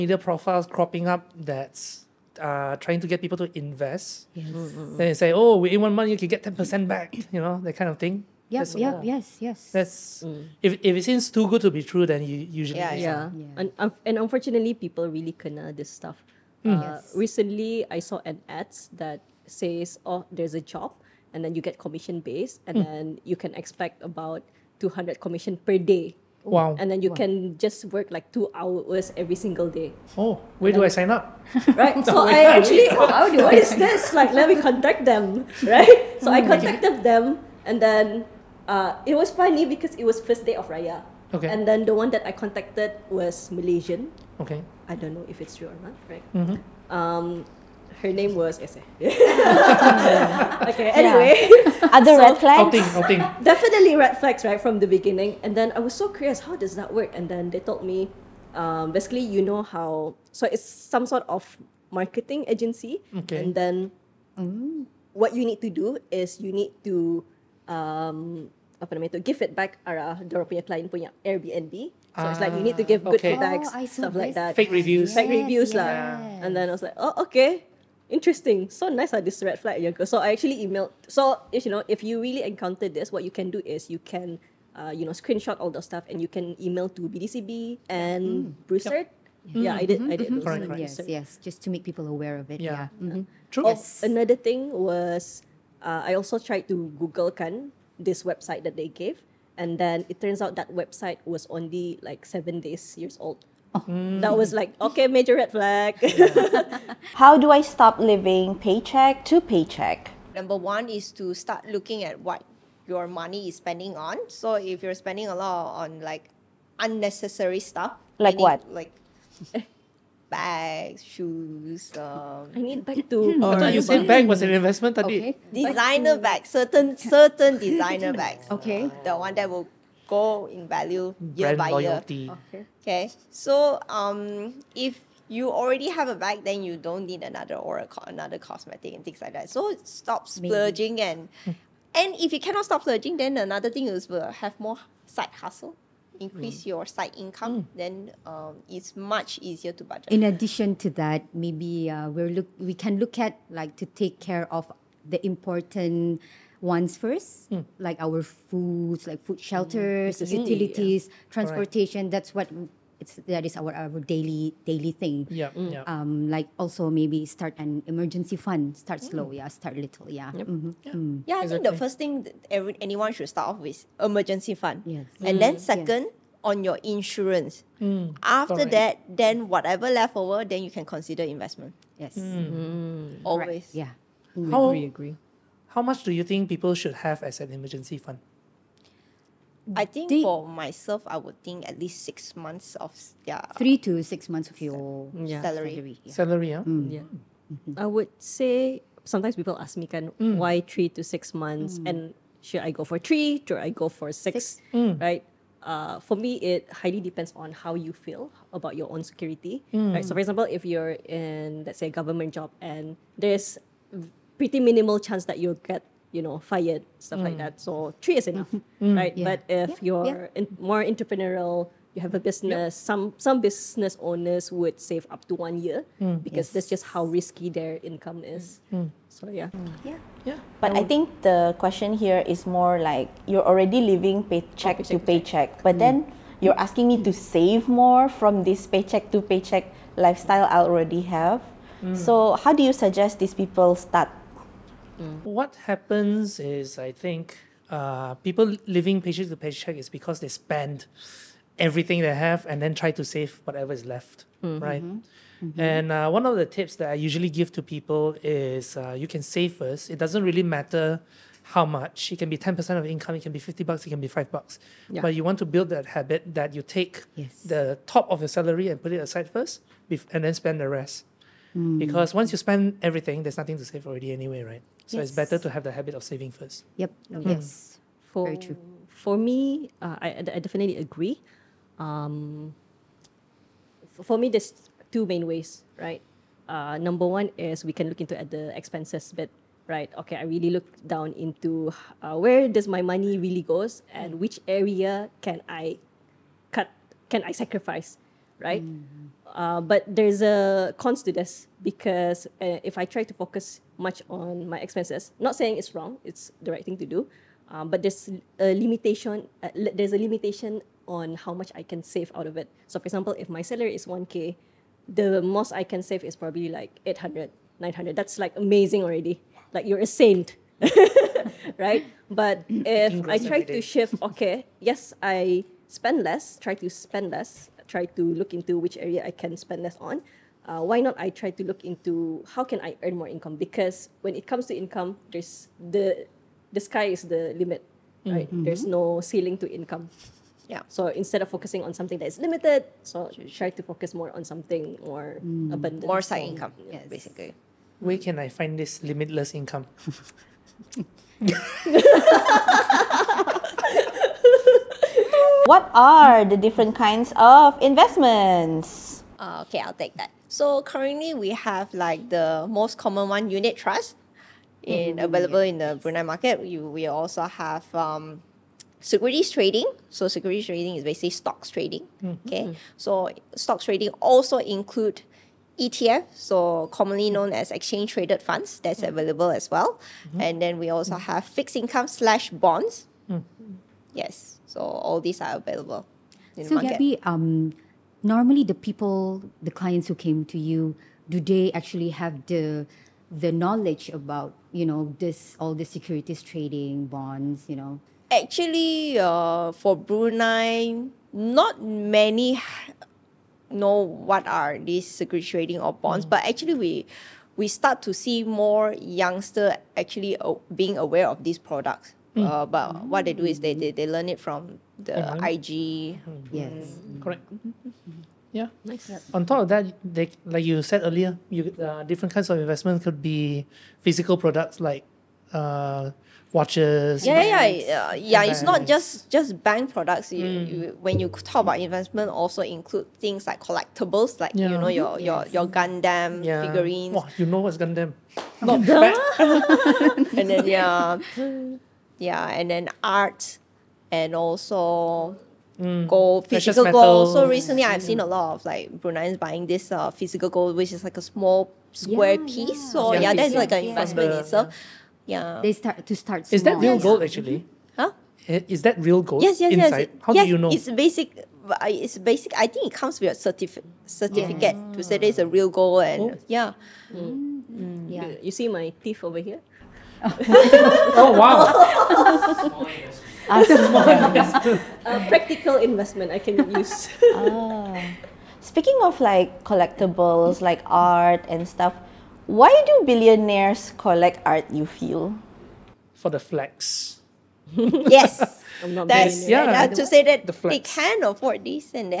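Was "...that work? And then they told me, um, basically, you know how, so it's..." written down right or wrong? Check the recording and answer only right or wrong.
right.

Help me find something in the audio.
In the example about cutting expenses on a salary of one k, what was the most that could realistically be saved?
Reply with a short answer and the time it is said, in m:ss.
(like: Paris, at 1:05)
800 to 900, at 5:16.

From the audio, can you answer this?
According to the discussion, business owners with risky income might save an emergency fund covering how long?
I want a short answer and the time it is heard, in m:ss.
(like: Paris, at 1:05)
1 year, at 3:45.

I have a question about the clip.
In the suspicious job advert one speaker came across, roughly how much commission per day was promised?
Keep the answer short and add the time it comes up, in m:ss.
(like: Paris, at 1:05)
200, at 0:24.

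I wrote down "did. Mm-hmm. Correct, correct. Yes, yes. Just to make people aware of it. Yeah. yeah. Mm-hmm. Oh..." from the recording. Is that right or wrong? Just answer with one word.
right.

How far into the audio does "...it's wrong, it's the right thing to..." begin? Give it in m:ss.
5:05.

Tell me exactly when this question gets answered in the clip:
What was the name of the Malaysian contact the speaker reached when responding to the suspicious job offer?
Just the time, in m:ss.
0:48.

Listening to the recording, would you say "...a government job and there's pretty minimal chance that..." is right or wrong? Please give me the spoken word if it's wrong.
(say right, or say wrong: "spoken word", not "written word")
right.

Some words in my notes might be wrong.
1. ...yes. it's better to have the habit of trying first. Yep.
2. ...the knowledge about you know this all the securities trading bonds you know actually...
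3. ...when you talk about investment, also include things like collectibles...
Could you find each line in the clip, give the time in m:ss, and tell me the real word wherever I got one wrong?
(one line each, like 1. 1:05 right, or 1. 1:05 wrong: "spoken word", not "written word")
1. 4:34 wrong: "saving", not "trying"
2. 6:33 right
3. 7:10 right.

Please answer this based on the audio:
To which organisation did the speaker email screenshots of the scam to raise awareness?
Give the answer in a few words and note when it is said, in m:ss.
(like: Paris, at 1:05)
BDCB, at 1:27.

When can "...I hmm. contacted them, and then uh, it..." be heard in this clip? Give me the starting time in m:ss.
0:36.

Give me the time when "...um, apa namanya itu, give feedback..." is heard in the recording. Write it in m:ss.
1:07.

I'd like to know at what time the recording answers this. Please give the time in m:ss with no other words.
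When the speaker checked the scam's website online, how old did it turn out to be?
1:42.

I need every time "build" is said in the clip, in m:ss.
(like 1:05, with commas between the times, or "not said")
4:25.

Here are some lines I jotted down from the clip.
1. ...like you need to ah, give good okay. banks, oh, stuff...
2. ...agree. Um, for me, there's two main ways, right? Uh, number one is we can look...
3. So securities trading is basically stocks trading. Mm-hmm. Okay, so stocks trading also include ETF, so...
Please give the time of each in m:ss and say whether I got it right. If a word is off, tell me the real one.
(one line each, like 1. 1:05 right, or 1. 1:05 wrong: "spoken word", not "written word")
1. 1:12 wrong: "feedbacks", not "banks"
2. 4:40 right
3. 6:09 right.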